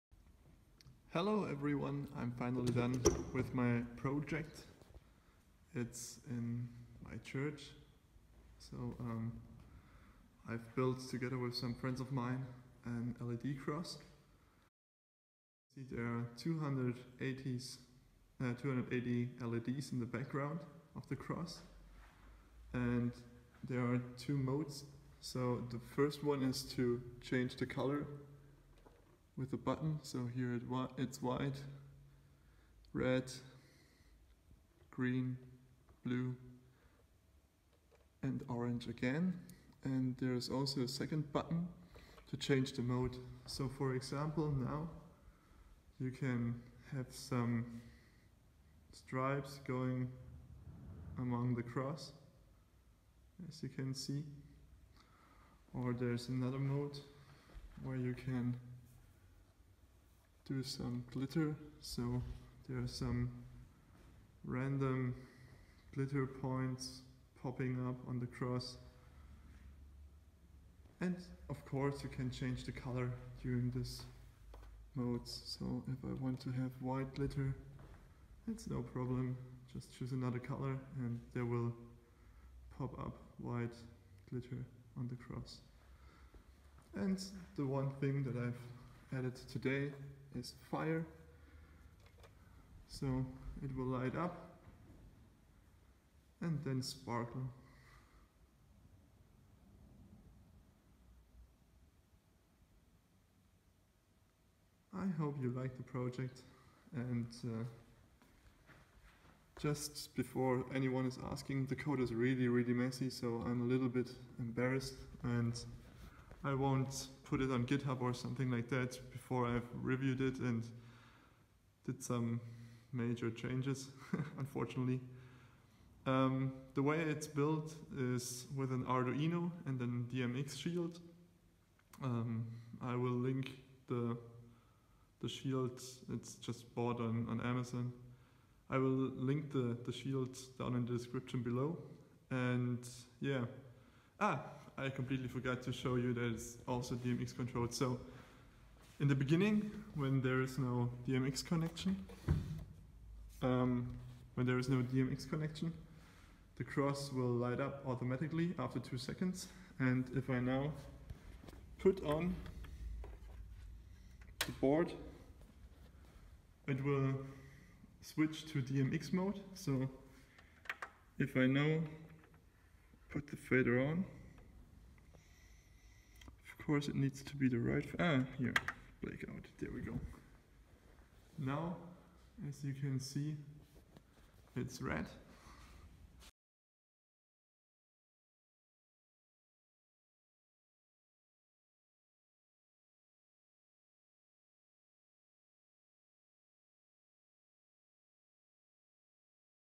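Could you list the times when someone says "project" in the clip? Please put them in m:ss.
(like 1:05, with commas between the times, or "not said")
0:03, 1:45.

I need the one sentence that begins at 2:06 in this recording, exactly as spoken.
Um, the way it's built is with an Arduino and an DMX shield.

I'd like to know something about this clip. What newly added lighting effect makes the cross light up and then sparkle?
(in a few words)
Fire.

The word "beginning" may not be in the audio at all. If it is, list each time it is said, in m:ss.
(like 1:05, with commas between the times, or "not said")
2:29.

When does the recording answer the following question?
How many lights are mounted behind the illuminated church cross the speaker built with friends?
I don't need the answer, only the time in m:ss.
0:18.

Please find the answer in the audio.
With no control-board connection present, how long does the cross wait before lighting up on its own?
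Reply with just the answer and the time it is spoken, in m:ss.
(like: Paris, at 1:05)
2 seconds, at 2:38.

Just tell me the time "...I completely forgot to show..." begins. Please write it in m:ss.
2:24.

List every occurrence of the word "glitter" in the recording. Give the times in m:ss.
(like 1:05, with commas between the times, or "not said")
1:01, 1:05, 1:17, 1:24.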